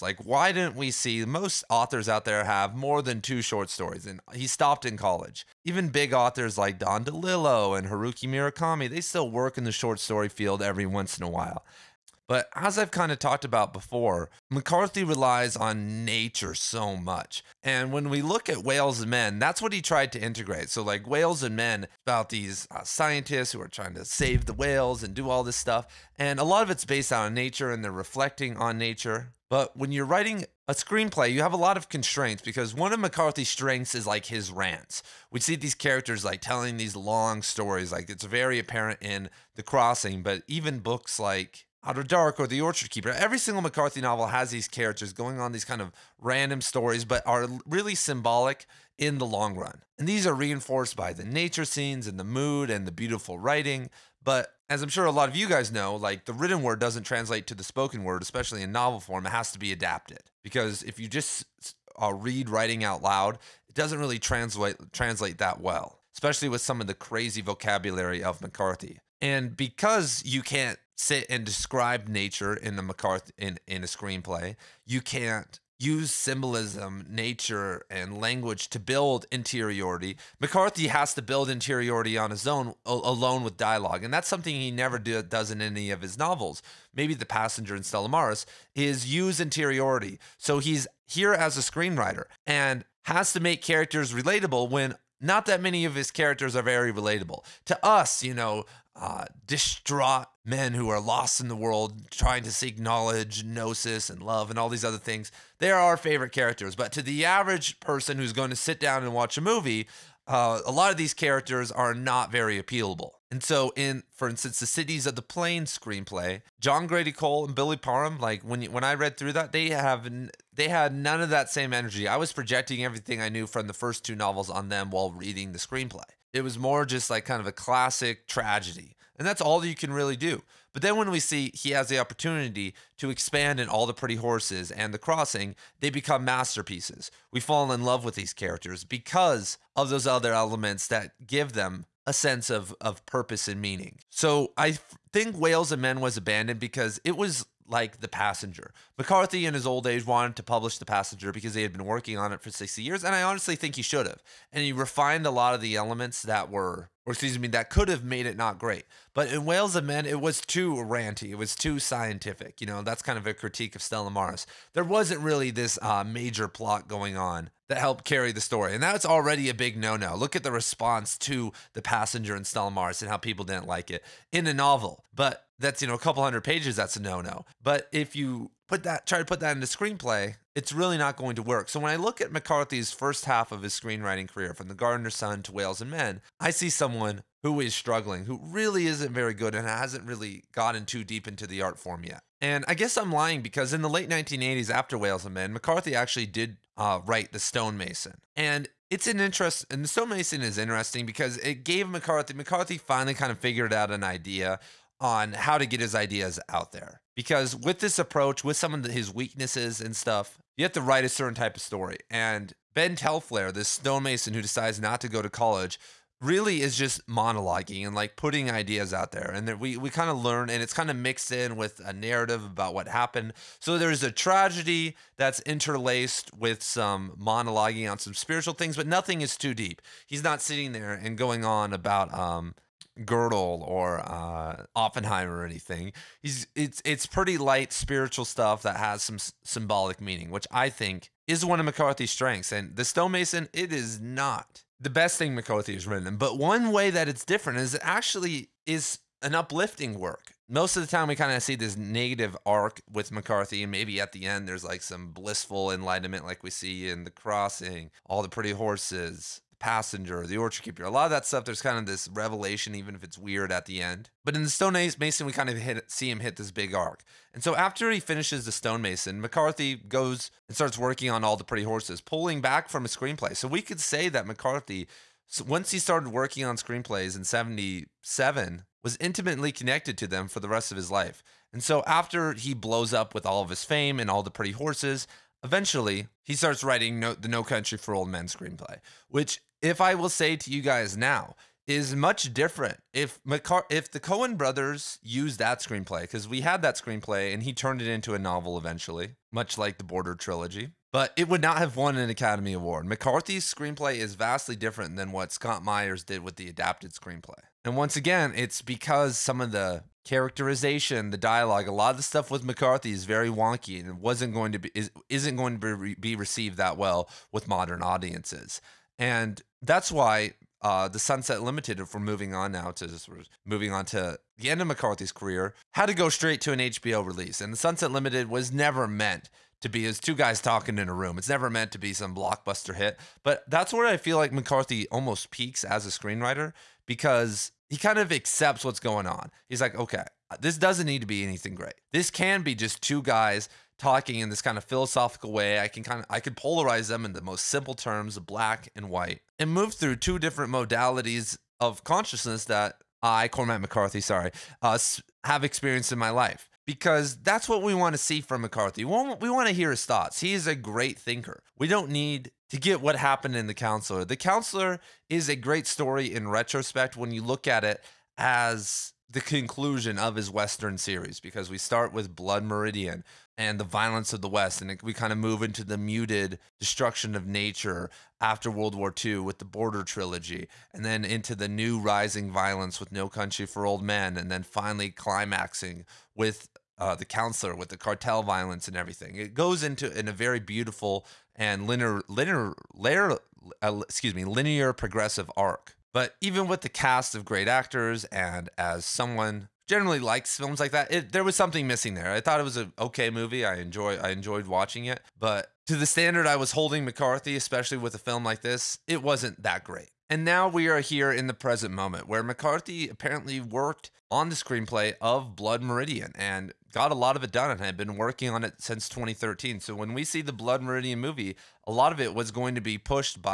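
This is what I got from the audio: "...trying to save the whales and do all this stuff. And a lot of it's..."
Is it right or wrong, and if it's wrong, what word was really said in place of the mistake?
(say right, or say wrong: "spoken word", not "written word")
right.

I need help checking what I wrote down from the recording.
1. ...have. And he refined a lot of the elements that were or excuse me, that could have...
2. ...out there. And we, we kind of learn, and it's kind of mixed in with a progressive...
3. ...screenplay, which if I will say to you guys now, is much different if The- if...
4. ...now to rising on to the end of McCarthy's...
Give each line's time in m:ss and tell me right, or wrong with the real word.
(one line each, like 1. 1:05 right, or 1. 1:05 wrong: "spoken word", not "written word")
1. 2:34 right
2. 3:38 wrong: "narrative", not "progressive"
3. 4:48 wrong: "McCar", not "The"
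4. 5:22 wrong: "moving", not "rising".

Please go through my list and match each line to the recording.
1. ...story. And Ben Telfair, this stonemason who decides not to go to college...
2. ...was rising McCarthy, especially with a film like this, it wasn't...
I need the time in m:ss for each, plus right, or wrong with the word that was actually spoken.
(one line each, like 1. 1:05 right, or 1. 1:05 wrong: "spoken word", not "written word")
1. 3:31 right
2. 6:46 wrong: "holding", not "rising".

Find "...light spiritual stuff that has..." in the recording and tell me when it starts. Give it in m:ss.
3:57.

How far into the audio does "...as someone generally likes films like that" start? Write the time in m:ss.
6:38.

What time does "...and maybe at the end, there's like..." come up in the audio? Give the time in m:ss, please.
4:13.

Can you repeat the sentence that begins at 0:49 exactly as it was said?
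And these are reinforced by the nature scenes and the mood and the beautiful writing.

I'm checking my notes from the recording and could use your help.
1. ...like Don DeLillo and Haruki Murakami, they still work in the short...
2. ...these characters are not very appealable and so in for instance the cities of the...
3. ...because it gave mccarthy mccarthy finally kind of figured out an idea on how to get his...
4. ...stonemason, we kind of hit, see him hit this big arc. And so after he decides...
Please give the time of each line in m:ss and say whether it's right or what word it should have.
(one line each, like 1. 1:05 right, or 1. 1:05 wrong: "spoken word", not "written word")
1. 0:06 right
2. 1:50 right
3. 3:21 right
4. 4:24 wrong: "finishes", not "decides".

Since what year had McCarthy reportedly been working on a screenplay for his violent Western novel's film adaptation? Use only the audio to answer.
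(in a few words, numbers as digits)
2013.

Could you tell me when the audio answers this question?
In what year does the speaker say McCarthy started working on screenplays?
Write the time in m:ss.
4:37.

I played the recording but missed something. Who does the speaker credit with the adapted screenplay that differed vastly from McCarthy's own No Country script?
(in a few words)
Scott Myers.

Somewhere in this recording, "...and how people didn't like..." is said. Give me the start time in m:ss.
2:53.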